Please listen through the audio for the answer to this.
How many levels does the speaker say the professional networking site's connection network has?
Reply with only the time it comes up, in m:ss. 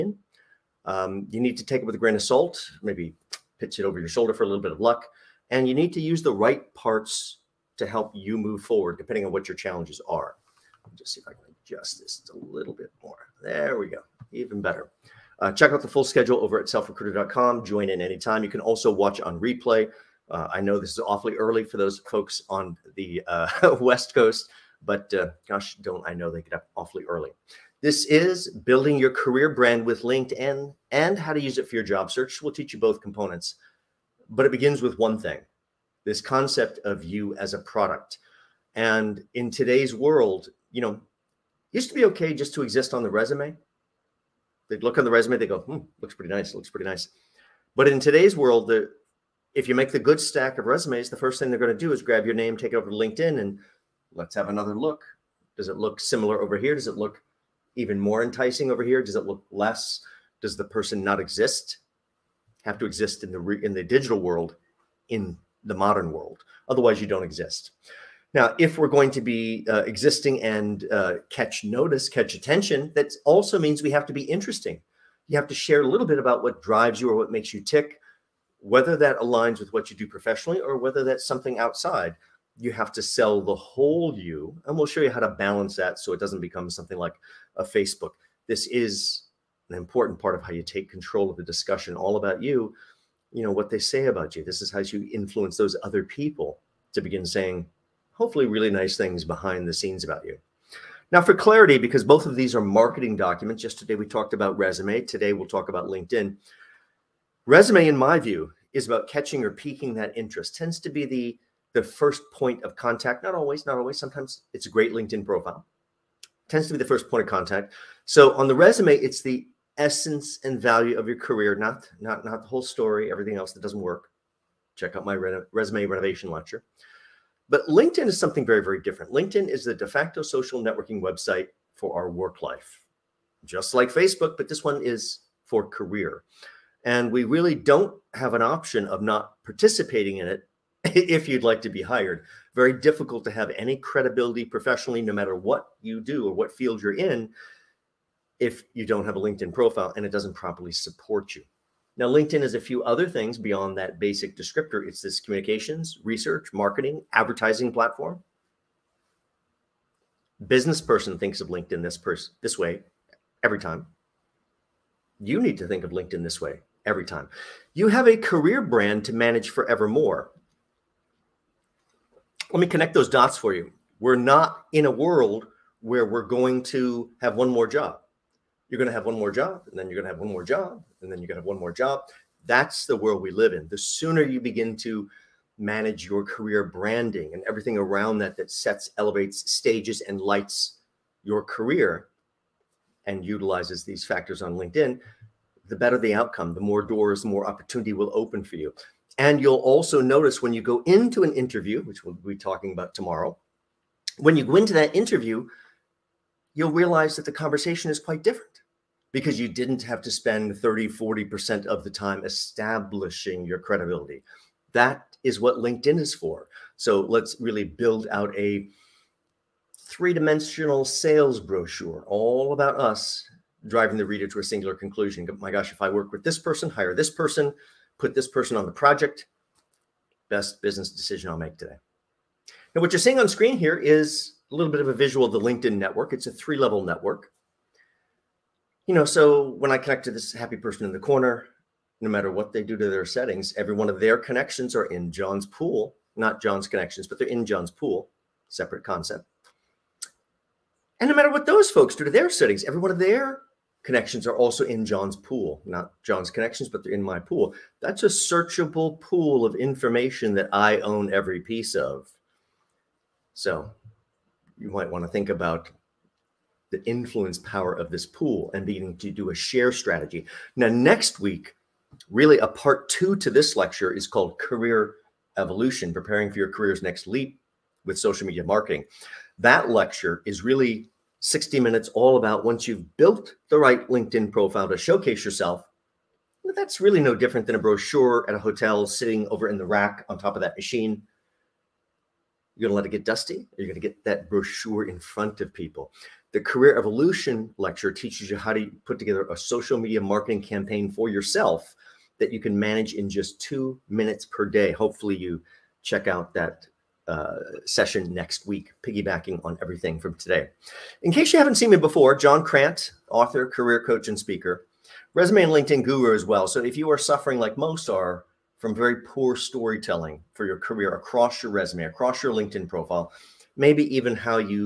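3:56.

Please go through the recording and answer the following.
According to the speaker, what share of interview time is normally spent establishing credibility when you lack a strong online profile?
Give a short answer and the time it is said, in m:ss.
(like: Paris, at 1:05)
30-40%, at 3:30.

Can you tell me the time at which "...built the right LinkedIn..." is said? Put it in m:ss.
4:42.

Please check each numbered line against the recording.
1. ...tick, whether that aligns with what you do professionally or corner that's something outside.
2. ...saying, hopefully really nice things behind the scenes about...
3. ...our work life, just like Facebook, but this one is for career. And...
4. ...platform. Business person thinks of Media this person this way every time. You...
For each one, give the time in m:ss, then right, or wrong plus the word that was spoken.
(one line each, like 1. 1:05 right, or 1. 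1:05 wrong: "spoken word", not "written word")
1. 1:17 wrong: "whether", not "corner"
2. 1:37 right
3. 2:11 right
4. 2:37 wrong: "LinkedIn", not "Media".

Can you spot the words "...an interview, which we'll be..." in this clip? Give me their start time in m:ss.
3:21.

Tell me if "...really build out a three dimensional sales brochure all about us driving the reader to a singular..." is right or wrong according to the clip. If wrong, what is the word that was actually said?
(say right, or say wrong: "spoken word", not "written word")
right.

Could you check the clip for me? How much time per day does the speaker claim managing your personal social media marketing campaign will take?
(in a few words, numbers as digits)
2 minutes.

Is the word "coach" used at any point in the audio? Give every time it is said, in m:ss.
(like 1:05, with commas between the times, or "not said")
5:13.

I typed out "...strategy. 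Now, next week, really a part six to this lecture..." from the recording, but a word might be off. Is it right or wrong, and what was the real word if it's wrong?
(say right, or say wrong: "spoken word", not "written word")
wrong: "two", not "six".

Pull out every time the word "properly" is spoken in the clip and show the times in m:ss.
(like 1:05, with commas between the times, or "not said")
2:30.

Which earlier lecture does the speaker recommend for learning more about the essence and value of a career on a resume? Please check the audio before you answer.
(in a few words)
Resume Renovation.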